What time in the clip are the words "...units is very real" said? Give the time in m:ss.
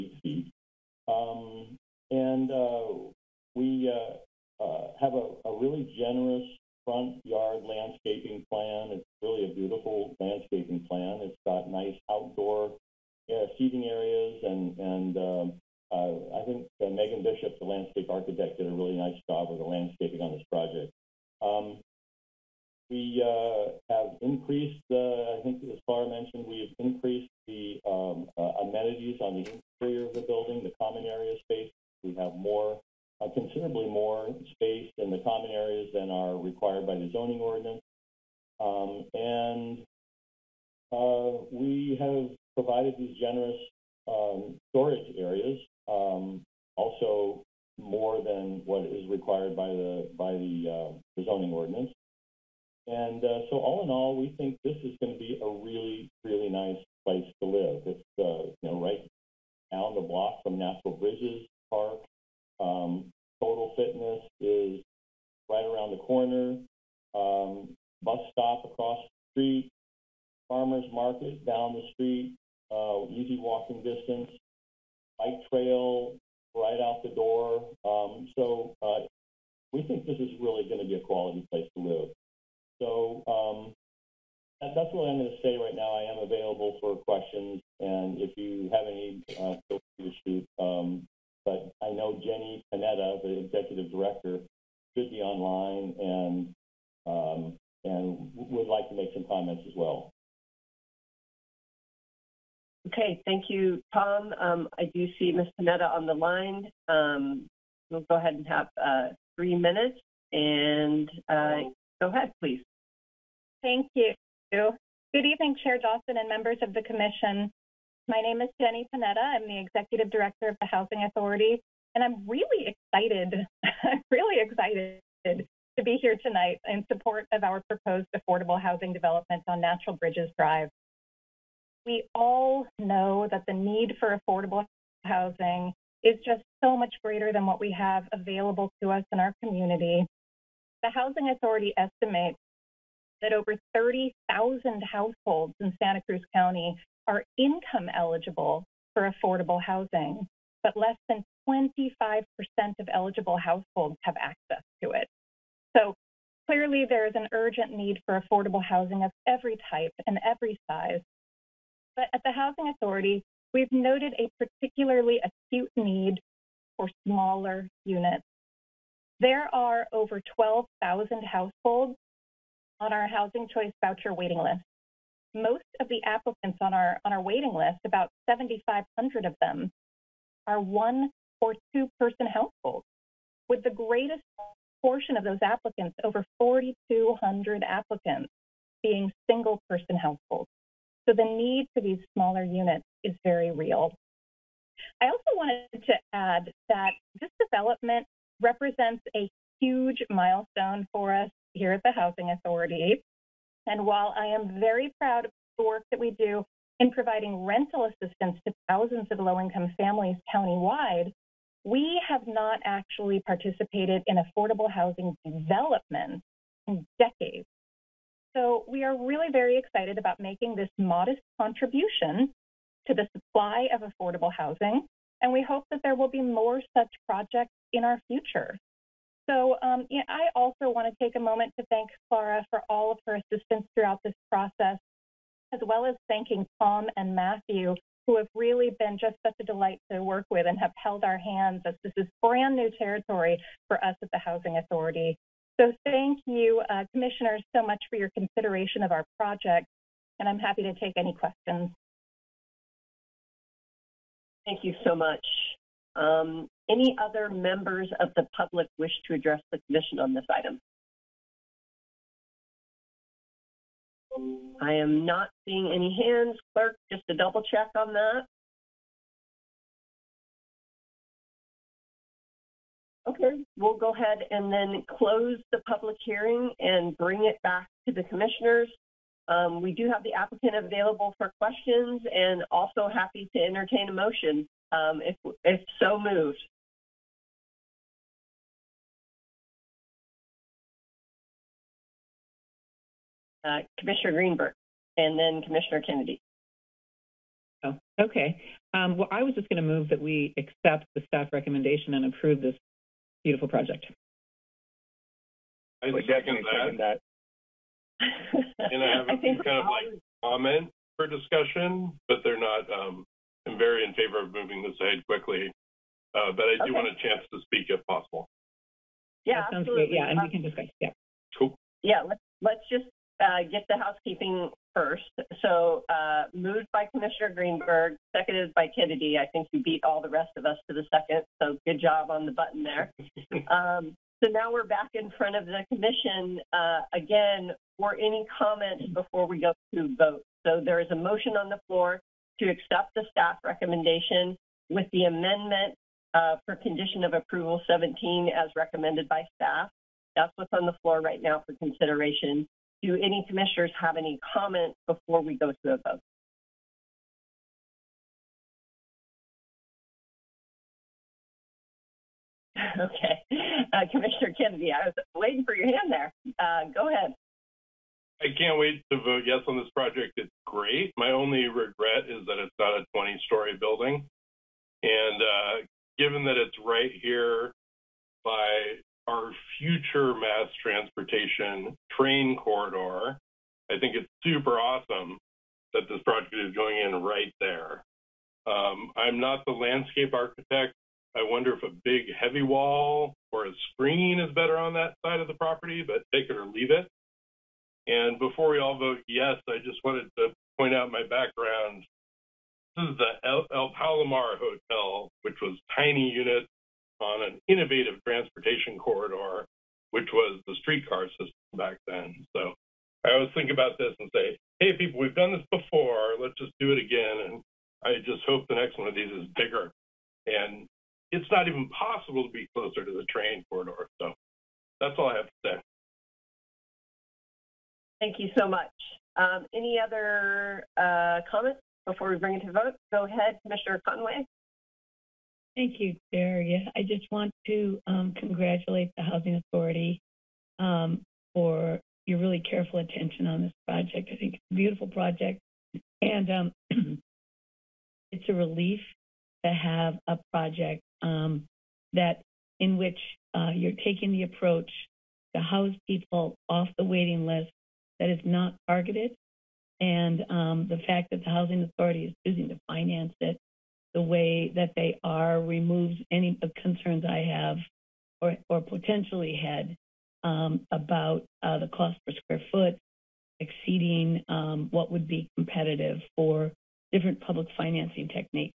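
3:12.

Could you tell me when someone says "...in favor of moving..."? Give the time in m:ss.
5:13.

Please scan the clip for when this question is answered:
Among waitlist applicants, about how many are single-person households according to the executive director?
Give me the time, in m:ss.
3:06.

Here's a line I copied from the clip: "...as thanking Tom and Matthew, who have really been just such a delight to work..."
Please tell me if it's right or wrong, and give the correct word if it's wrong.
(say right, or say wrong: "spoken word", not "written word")
right.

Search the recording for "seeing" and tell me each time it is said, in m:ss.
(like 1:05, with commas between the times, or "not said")
4:25.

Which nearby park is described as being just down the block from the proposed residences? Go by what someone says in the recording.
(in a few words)
Natural Bridges Park.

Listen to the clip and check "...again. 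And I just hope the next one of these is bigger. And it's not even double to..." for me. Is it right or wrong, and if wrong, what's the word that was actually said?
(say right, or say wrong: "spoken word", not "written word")
wrong: "possible", not "double".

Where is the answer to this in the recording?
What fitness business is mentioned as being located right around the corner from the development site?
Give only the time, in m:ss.
1:03.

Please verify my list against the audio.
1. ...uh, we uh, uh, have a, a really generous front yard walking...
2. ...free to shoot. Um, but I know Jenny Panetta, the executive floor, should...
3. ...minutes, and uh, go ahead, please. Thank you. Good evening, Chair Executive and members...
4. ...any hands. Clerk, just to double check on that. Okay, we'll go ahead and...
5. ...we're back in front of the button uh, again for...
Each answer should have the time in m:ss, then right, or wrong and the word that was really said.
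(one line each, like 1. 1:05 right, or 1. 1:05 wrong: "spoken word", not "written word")
1. 0:02 wrong: "landscaping", not "walking"
2. 1:29 wrong: "director", not "floor"
3. 1:49 wrong: "Dawson", not "Executive"
4. 4:25 right
5. 5:34 wrong: "commission", not "button".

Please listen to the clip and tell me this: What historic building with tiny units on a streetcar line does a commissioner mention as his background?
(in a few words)
El Palomar Hotel.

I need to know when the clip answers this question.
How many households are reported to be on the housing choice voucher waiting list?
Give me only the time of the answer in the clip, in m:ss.
2:50.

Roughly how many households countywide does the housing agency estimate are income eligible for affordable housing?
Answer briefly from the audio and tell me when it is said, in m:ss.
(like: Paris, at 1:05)
30,000, at 2:23.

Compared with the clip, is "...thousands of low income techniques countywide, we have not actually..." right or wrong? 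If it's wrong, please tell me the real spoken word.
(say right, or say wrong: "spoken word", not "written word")
wrong: "families", not "techniques".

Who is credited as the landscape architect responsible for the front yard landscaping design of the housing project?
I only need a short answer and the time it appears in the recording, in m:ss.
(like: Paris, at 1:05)
Megan Bishop, at 0:16.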